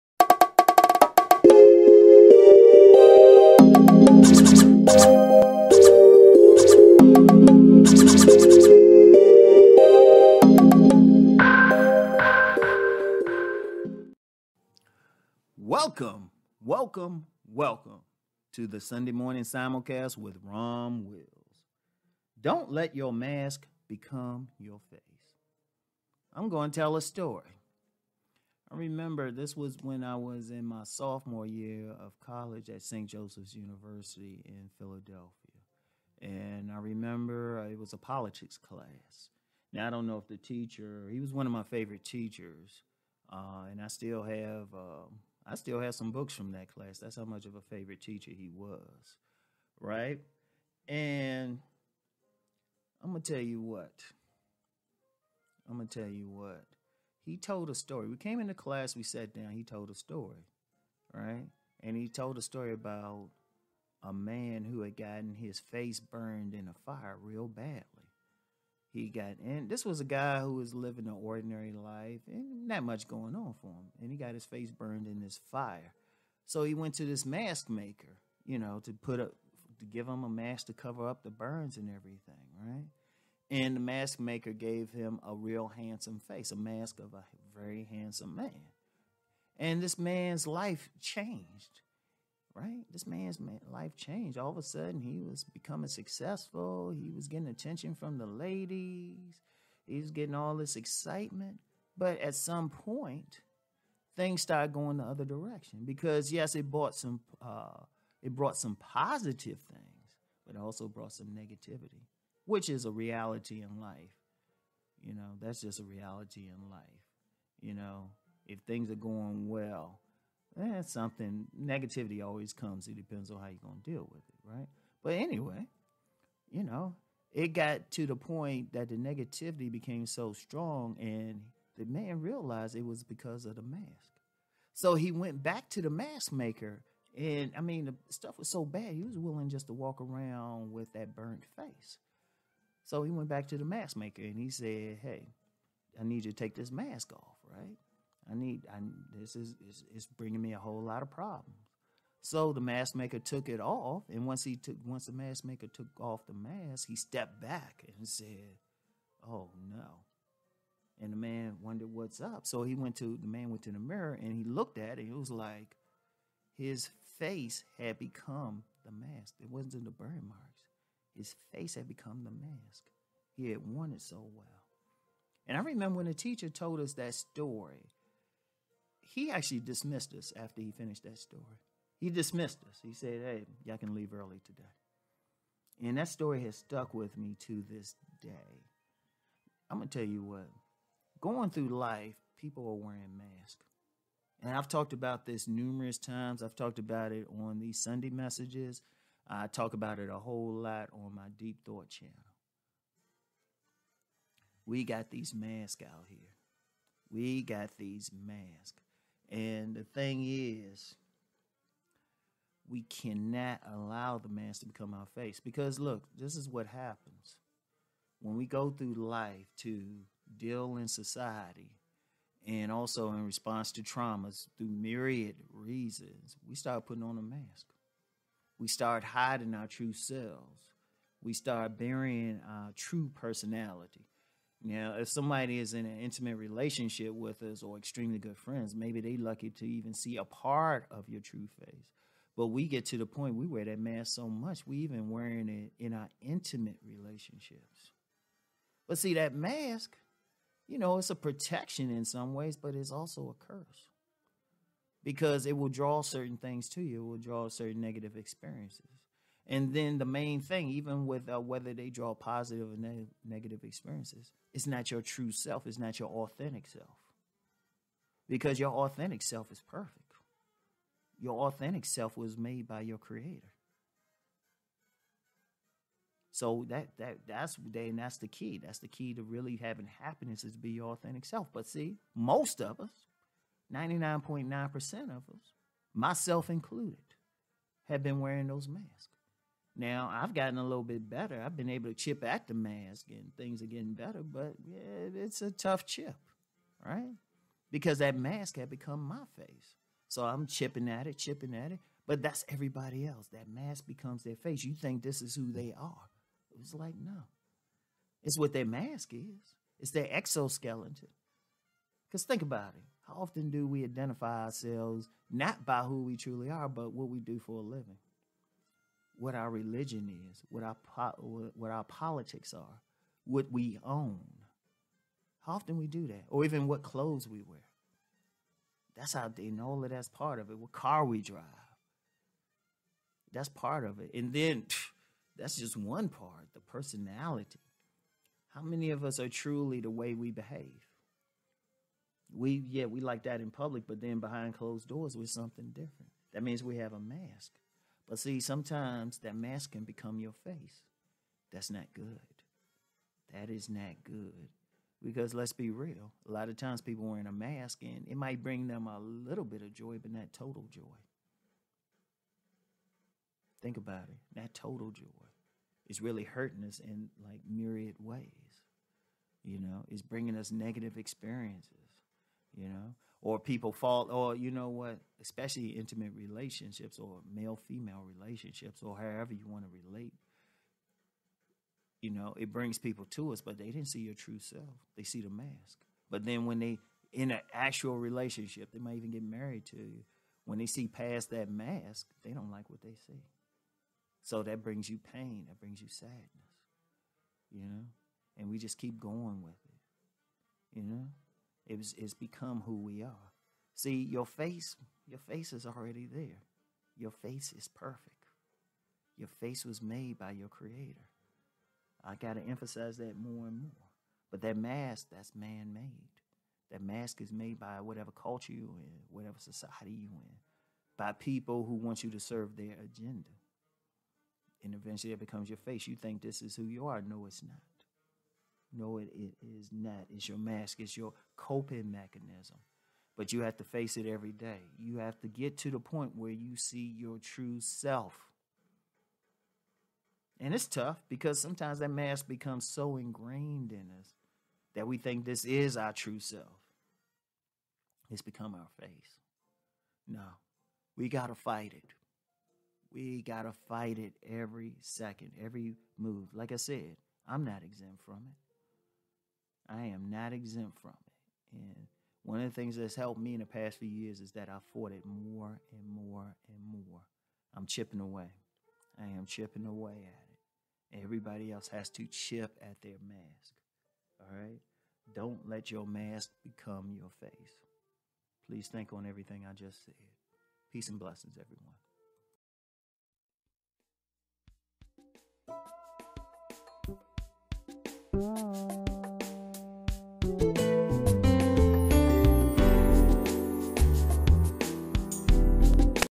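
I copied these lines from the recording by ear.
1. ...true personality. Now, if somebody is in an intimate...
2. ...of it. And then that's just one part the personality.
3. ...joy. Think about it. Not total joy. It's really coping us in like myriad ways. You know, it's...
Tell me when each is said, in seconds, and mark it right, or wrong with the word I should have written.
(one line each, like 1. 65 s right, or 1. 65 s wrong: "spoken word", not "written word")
1. 232 s right
2. 333 s right
3. 360 s wrong: "hurting", not "coping".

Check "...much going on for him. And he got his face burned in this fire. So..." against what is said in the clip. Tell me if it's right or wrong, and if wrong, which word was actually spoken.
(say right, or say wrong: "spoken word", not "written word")
right.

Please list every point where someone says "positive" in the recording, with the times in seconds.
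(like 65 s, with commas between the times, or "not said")
108 s, 262 s.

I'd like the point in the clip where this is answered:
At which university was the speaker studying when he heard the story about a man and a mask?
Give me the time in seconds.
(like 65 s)
32 s.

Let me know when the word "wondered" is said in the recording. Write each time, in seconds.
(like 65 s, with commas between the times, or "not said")
161 s.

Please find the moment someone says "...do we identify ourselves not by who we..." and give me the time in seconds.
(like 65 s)
313 s.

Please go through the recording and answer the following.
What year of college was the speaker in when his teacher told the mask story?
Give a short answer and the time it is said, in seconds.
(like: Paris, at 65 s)
Sophomore, at 30 s.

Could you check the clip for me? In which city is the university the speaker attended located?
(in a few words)
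Philadelphia.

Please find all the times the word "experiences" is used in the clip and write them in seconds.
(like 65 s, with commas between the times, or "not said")
258 s, 263 s, 370 s.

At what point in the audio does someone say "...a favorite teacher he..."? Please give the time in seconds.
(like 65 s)
47 s.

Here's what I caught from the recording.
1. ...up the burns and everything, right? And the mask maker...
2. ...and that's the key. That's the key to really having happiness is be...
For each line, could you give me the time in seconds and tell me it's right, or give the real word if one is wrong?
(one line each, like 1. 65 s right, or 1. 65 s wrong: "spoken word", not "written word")
1. 81 s right
2. 277 s right.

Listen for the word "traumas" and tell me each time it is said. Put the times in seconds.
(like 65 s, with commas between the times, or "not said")
223 s.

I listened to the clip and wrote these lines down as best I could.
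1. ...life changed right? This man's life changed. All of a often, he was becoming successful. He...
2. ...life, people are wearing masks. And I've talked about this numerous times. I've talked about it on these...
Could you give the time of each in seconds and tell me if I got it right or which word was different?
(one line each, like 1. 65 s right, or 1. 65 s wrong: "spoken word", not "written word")
1. 90 s wrong: "sudden", not "often"
2. 191 s right.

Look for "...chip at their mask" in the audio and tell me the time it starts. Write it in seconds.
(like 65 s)
472 s.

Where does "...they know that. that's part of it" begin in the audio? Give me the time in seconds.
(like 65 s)
329 s.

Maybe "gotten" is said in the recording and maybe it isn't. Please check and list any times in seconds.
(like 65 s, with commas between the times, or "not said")
64 s, 290 s.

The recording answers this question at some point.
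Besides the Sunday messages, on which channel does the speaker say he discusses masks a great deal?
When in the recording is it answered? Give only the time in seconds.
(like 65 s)
201 s.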